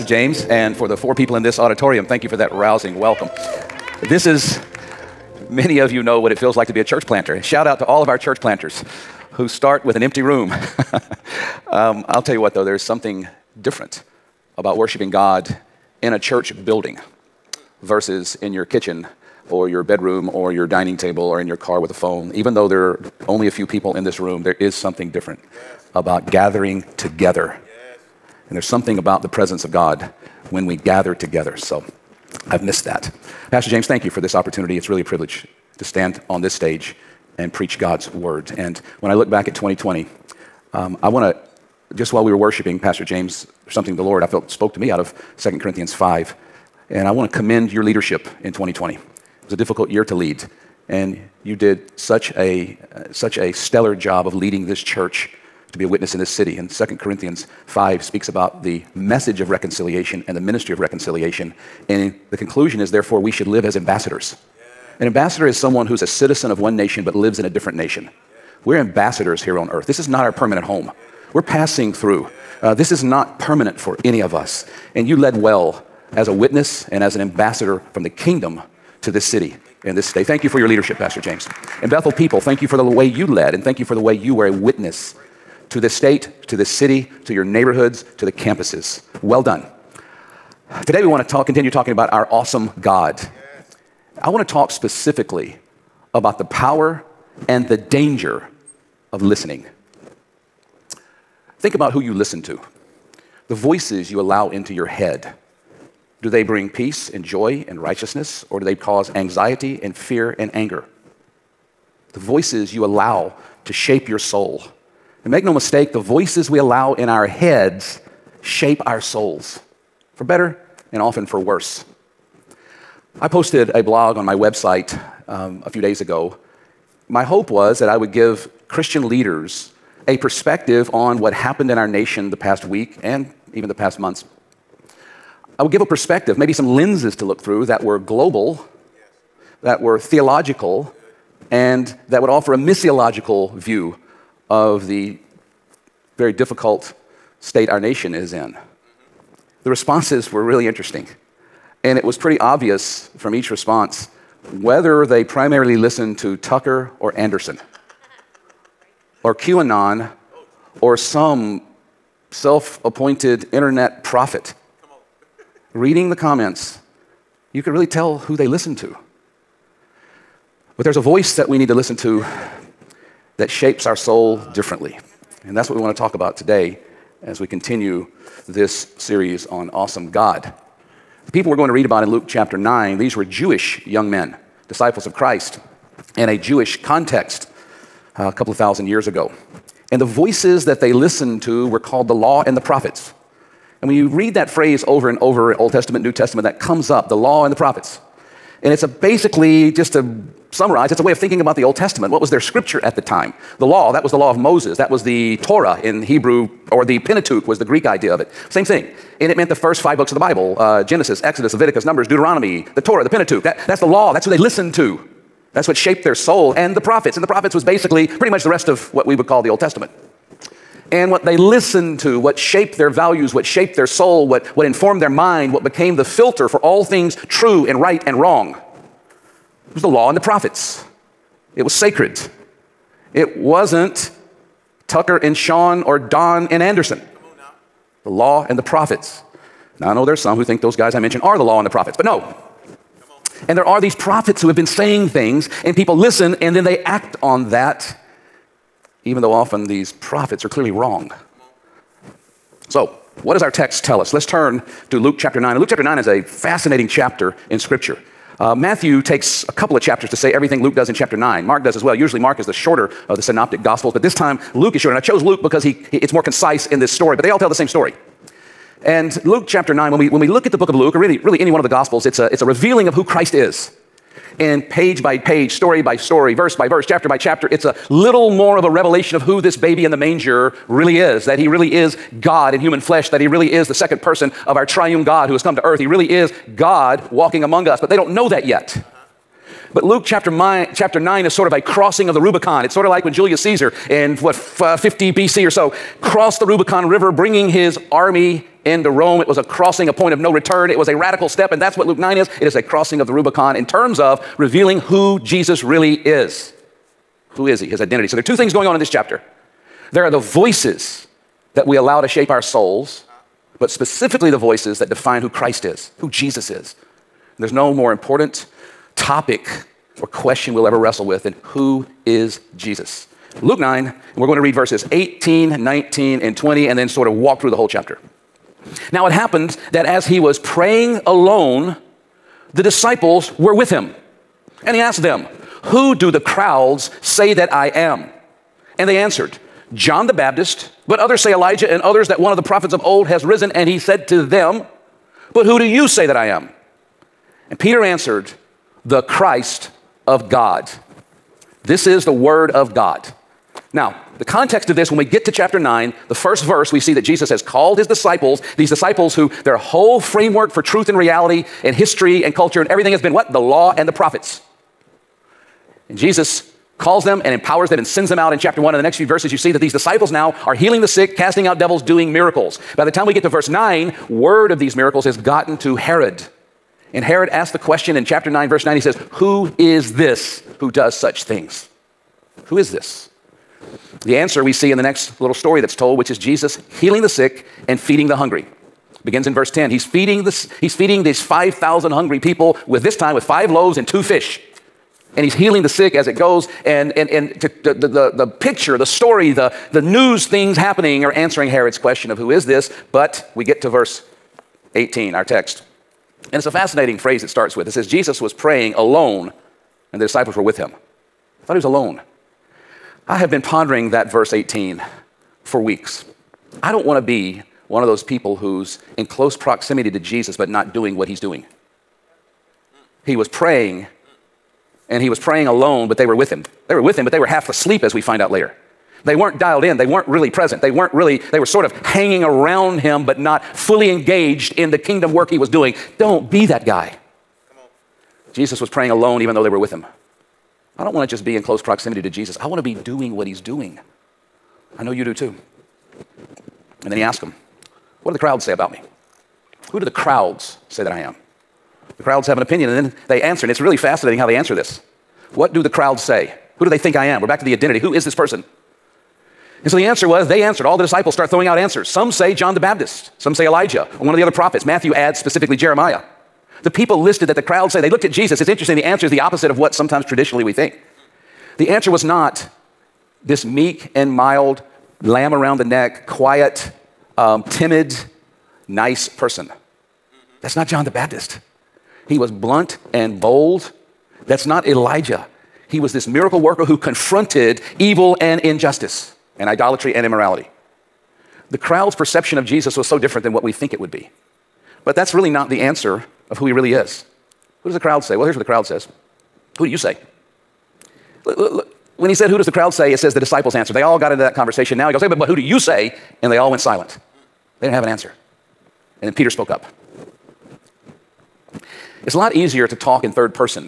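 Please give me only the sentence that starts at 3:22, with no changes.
What was their scripture at the time?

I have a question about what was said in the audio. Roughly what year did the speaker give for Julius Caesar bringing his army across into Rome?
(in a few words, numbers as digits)
50 BC.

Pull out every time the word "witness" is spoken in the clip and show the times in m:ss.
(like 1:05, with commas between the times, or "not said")
0:55, 1:16, 1:24.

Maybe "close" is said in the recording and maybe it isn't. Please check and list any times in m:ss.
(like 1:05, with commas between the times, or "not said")
6:59, 7:21.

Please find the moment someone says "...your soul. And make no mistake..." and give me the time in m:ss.
1:54.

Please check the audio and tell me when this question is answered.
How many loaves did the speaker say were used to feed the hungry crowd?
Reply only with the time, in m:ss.
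6:33.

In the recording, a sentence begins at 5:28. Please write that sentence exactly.
Now it happened that as he was praying alone, the disciples were with him.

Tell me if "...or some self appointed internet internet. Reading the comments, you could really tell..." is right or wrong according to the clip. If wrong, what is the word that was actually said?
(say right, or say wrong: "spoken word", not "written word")
wrong: "prophet", not "internet".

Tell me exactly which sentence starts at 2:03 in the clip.
I posted a blog on my website um, a few days ago.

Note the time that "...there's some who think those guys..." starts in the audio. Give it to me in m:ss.
4:00.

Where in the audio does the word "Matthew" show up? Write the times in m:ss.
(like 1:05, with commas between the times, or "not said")
4:18, 7:44.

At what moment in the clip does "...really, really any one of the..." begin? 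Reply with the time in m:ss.
4:30.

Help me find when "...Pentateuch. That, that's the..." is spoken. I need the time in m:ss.
3:33.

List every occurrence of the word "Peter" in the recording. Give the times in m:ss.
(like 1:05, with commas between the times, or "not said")
5:47, 8:29.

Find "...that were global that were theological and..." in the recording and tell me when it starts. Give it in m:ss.
2:17.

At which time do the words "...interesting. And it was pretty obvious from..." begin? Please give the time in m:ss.
2:30.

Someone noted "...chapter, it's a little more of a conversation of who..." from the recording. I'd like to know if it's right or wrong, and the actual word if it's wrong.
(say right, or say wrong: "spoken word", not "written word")
wrong: "revelation", not "conversation".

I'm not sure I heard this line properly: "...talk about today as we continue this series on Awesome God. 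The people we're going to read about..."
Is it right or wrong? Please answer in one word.
right.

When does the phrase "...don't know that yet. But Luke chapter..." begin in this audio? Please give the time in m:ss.
4:47.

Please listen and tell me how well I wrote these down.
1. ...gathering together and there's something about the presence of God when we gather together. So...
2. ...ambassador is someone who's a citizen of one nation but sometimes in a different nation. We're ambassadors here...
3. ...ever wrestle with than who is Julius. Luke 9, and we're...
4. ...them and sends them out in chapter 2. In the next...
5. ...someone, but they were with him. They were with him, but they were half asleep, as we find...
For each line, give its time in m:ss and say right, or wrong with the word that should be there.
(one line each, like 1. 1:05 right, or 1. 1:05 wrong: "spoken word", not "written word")
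1. 0:26 right
2. 1:05 wrong: "lives", not "sometimes"
3. 5:20 wrong: "Jesus", not "Julius"
4. 6:07 wrong: "1", not "2"
5. 7:05 wrong: "alone", not "someone".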